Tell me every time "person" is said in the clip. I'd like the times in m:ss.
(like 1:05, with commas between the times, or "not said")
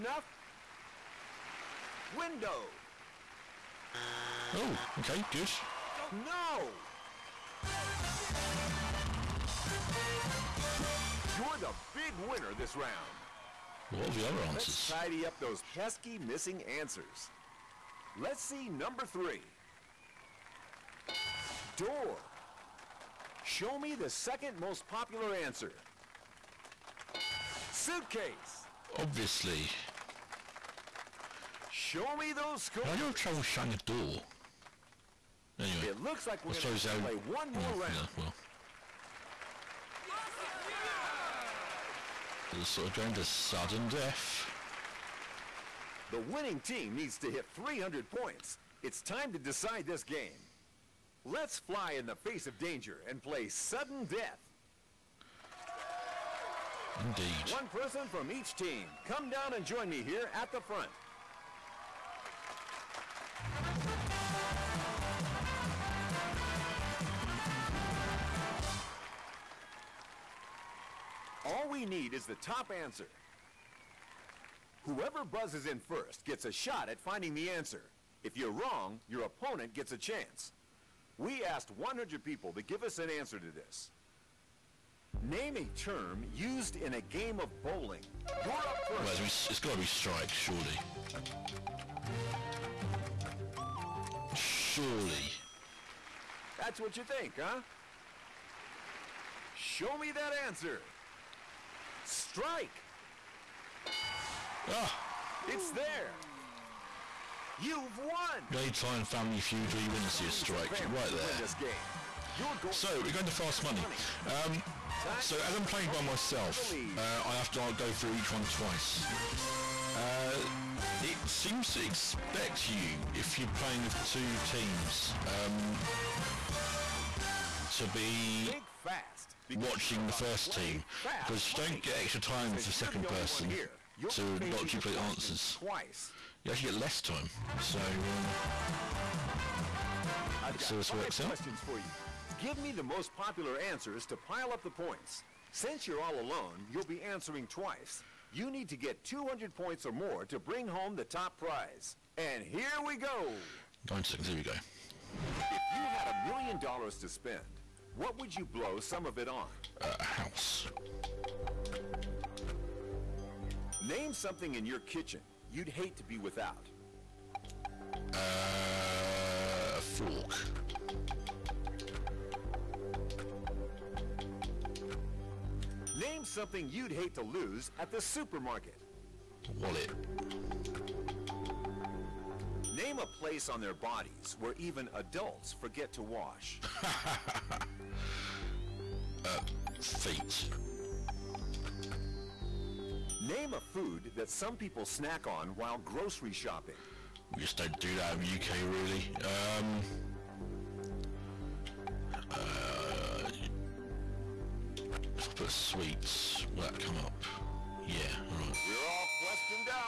0:57, 2:13.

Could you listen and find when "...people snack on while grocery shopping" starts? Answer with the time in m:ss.
3:14.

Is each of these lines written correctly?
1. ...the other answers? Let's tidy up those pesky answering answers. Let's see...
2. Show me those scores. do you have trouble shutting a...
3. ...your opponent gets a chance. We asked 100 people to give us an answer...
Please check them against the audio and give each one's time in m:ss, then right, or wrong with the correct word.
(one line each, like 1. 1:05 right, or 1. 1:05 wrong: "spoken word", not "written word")
1. 0:14 wrong: "missing", not "answering"
2. 0:31 right
3. 1:19 right.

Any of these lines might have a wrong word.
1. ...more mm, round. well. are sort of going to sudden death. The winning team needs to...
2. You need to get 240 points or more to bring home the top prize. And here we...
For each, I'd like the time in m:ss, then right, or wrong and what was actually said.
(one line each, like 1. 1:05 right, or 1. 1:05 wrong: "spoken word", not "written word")
1. 0:37 right
2. 2:28 wrong: "200", not "240".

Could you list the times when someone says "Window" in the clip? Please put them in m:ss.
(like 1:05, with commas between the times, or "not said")
0:02.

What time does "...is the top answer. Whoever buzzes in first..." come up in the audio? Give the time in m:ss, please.
1:12.